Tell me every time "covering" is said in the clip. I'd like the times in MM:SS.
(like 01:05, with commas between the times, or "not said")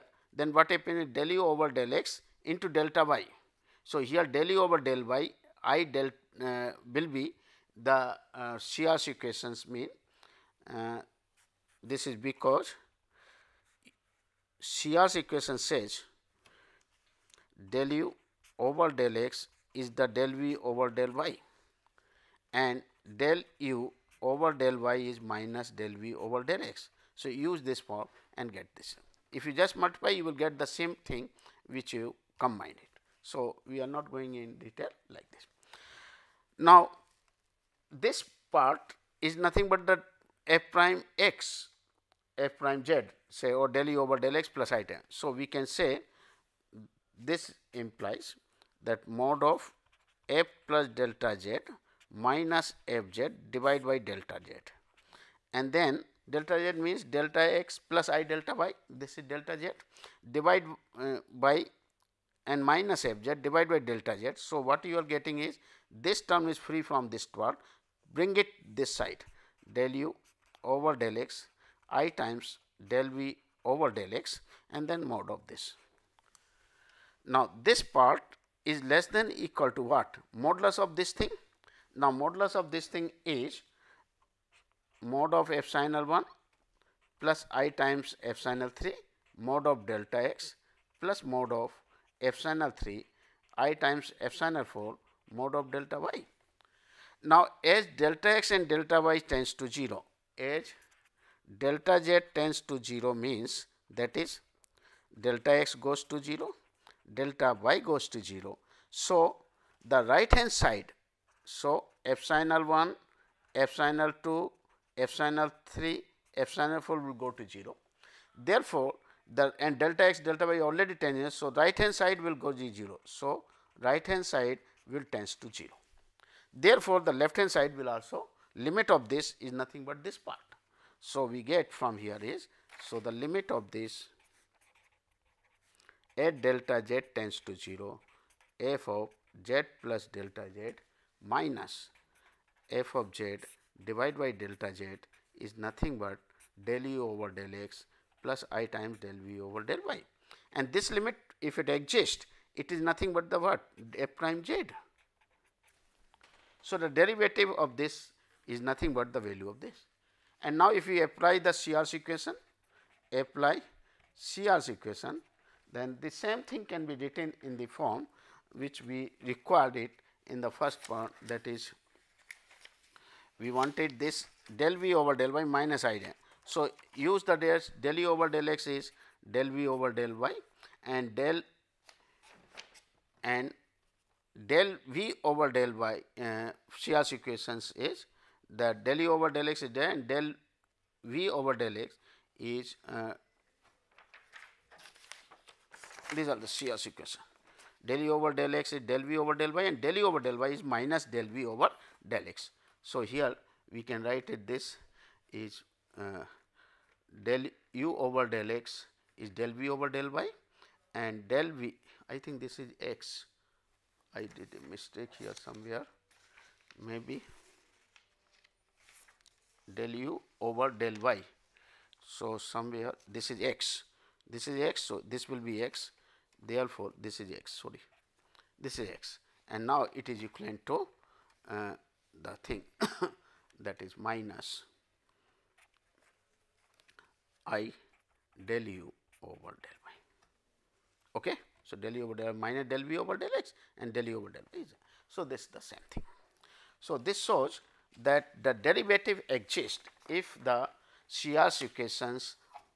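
not said.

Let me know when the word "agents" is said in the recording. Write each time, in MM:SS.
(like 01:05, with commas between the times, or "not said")
not said.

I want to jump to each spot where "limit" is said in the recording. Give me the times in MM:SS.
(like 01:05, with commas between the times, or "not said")
02:08, 02:13, 02:30.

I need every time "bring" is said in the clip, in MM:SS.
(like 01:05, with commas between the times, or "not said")
01:08.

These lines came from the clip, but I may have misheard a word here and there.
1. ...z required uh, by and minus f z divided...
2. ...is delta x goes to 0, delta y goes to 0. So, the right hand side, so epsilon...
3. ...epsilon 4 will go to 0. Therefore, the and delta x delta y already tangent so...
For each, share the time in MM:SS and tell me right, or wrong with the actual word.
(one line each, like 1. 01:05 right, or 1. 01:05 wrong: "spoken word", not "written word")
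1. 00:59 wrong: "divided", not "required"
2. 01:44 right
3. 01:56 right.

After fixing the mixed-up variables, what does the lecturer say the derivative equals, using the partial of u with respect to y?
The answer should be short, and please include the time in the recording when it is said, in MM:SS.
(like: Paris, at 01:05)
minus i del u over del y, at 03:53.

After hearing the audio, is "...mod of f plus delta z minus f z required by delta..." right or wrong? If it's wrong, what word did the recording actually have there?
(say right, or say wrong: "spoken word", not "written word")
wrong: "divided", not "required".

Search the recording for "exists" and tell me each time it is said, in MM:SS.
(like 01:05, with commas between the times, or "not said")
02:31, 04:09.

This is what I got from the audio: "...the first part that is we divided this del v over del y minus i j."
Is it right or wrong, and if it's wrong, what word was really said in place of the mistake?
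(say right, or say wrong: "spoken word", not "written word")
wrong: "wanted", not "divided".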